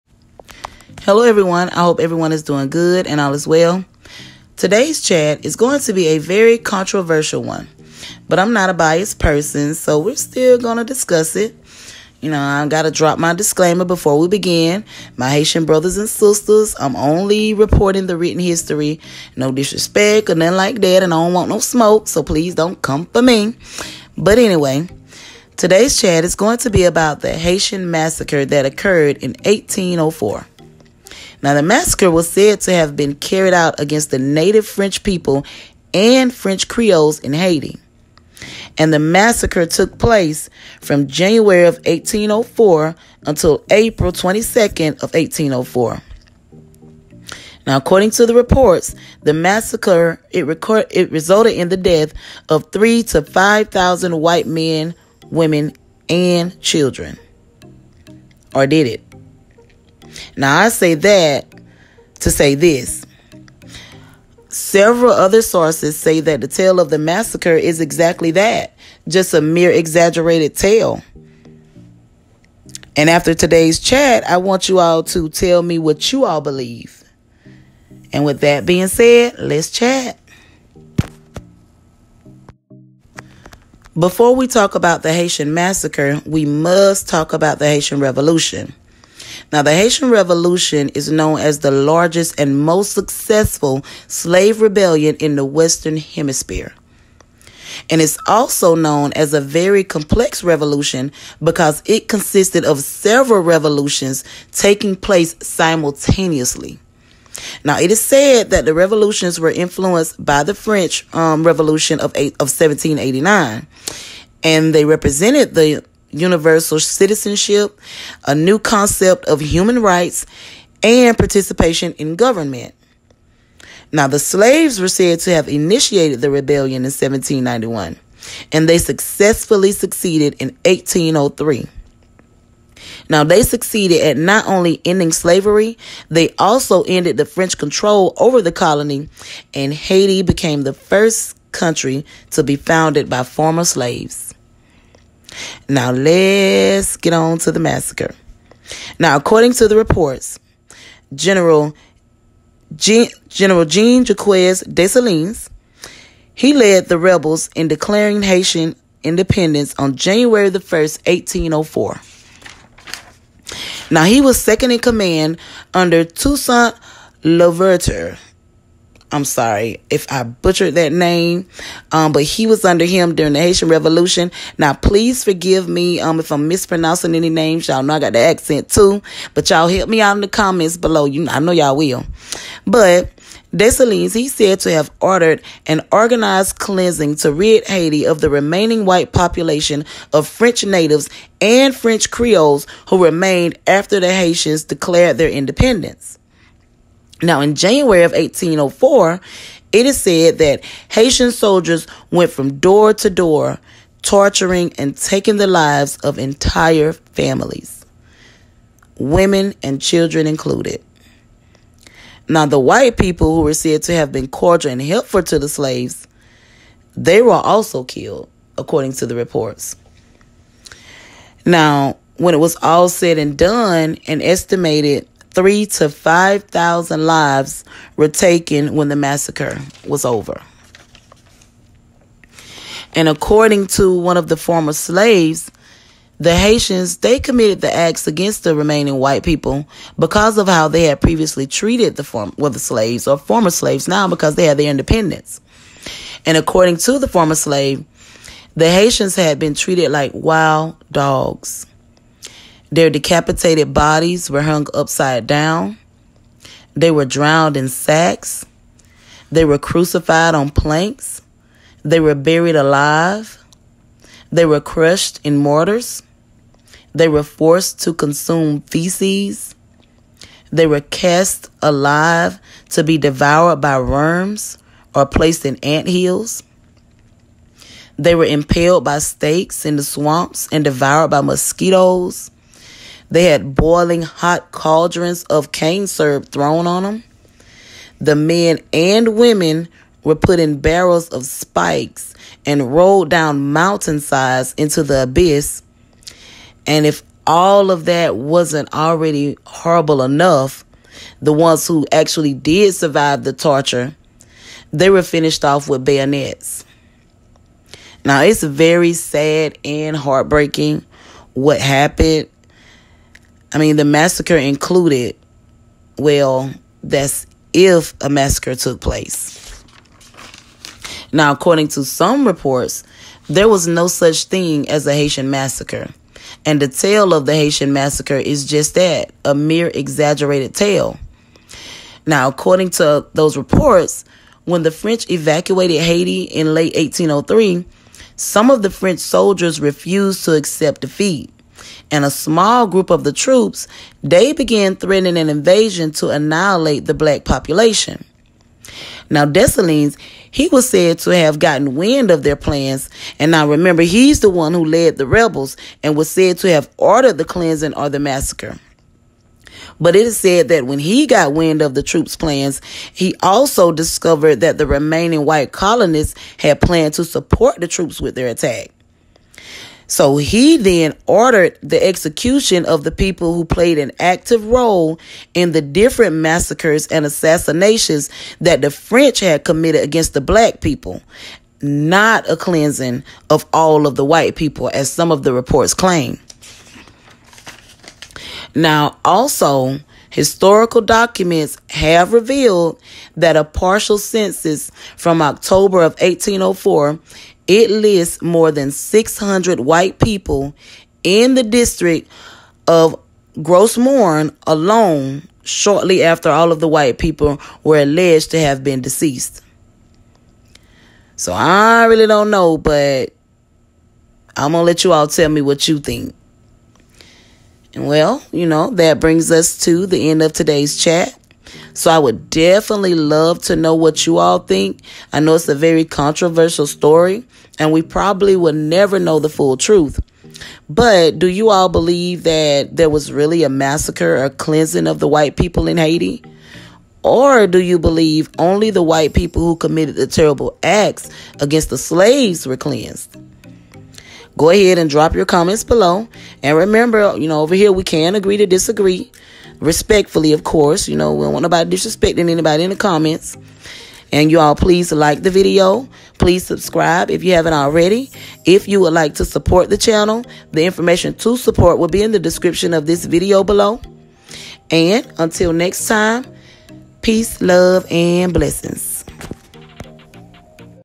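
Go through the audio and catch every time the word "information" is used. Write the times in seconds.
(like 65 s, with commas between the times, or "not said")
460 s.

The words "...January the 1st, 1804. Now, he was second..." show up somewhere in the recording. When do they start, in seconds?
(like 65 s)
159 s.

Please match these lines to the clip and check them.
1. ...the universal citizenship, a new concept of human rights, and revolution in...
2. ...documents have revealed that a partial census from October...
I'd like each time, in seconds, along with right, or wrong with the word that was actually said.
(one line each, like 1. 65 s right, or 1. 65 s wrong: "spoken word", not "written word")
1. 115 s wrong: "participation", not "revolution"
2. 390 s right.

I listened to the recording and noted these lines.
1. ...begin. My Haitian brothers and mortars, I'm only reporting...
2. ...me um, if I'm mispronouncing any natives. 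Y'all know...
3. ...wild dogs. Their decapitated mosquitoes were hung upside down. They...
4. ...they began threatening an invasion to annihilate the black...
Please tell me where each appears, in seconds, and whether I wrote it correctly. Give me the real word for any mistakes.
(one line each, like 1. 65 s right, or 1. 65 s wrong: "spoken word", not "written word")
1. 14 s wrong: "sisters", not "mortars"
2. 175 s wrong: "names", not "natives"
3. 250 s wrong: "bodies", not "mosquitoes"
4. 344 s right.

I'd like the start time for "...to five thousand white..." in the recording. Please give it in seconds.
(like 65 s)
53 s.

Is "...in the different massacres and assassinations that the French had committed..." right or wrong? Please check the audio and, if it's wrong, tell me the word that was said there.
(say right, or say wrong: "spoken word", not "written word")
right.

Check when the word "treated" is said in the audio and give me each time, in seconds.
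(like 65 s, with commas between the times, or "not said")
241 s, 249 s.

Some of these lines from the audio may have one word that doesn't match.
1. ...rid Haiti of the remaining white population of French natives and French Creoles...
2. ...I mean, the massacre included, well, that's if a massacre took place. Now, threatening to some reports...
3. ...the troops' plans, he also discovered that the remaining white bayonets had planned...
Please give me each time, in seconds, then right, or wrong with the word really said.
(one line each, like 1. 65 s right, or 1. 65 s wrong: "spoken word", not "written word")
1. 187 s right
2. 313 s wrong: "according", not "threatening"
3. 361 s wrong: "colonists", not "bayonets".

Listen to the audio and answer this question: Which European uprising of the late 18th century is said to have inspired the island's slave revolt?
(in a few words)
French Revolution of 1789.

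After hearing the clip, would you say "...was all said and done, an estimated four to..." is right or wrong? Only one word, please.
wrong.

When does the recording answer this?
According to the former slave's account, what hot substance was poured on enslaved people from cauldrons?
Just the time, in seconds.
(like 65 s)
285 s.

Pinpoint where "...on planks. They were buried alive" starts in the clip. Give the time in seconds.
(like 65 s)
260 s.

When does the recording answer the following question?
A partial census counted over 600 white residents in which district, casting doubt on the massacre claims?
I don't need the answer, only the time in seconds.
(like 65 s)
403 s.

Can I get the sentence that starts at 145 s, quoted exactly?
Now let's get on to the massacre.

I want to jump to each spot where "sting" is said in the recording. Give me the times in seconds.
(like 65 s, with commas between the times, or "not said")
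not said.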